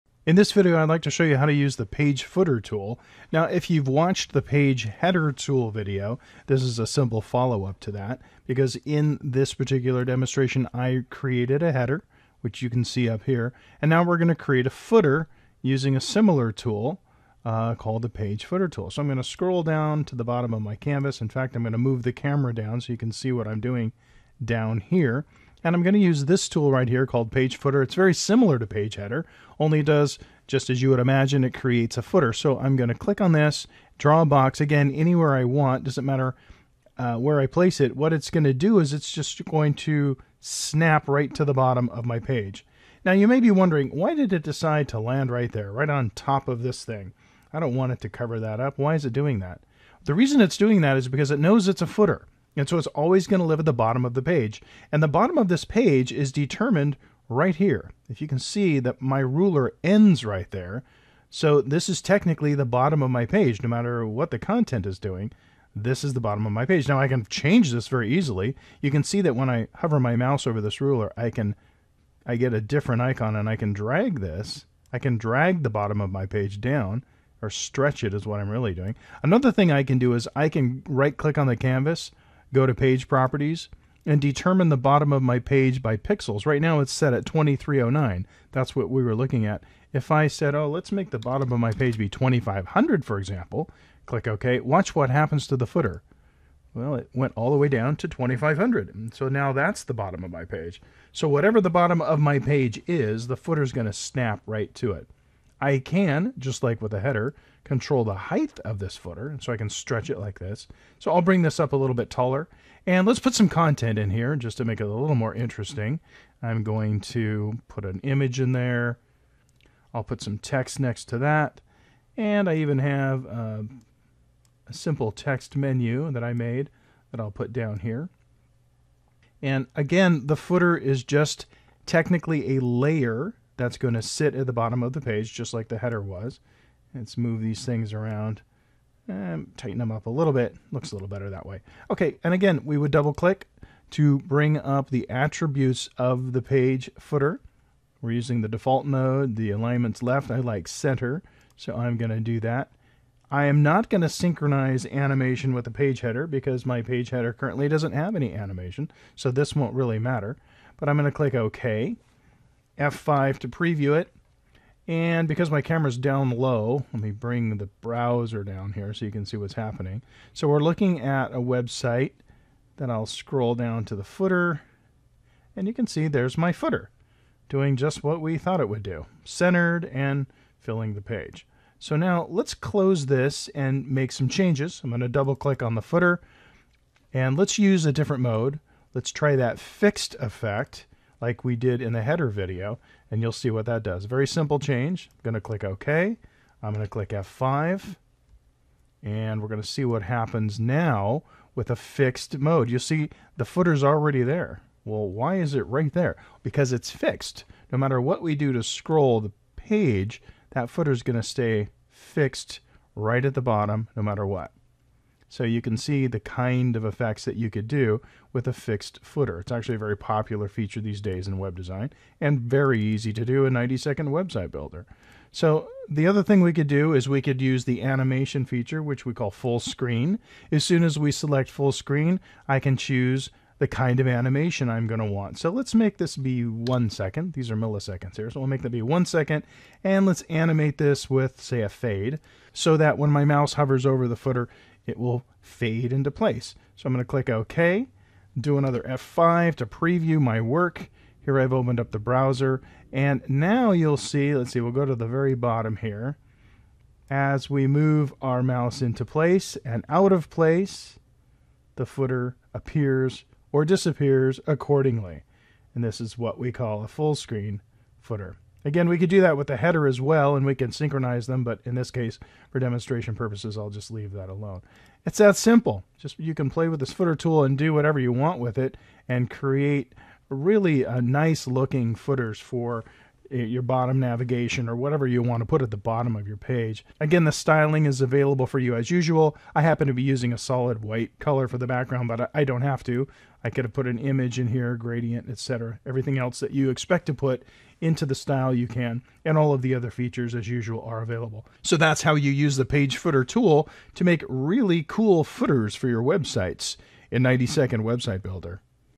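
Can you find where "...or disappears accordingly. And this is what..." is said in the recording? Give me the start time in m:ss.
4:23.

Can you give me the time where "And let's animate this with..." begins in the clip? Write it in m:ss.
3:59.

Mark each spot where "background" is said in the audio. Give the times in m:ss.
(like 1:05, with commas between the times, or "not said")
4:51.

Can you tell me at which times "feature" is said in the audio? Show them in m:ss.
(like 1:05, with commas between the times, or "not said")
3:40, 3:48, 4:59.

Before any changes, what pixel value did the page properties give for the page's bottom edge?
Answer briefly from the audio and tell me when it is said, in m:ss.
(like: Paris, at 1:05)
2309, at 1:27.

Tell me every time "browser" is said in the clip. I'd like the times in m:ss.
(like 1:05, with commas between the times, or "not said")
2:47, 4:11.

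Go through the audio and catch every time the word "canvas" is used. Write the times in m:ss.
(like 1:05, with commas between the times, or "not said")
0:20, 1:21.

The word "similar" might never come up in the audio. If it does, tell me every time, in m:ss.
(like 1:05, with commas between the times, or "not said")
0:16, 0:28.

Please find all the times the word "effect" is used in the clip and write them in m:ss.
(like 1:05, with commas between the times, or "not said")
3:10, 3:36.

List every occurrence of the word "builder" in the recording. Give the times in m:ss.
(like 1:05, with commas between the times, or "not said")
3:44, 5:08.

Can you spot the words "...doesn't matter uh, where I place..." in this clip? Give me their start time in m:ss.
0:35.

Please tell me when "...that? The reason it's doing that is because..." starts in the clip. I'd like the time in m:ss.
0:49.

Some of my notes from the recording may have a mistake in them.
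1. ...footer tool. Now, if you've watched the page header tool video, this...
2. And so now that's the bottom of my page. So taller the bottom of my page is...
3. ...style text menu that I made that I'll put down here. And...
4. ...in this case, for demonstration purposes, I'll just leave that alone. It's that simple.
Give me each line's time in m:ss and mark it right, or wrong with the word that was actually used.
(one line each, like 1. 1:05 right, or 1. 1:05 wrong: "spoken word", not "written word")
1. 0:02 right
2. 1:38 wrong: "whatever", not "taller"
3. 2:04 wrong: "simple", not "style"
4. 4:31 right.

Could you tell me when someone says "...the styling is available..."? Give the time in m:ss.
4:47.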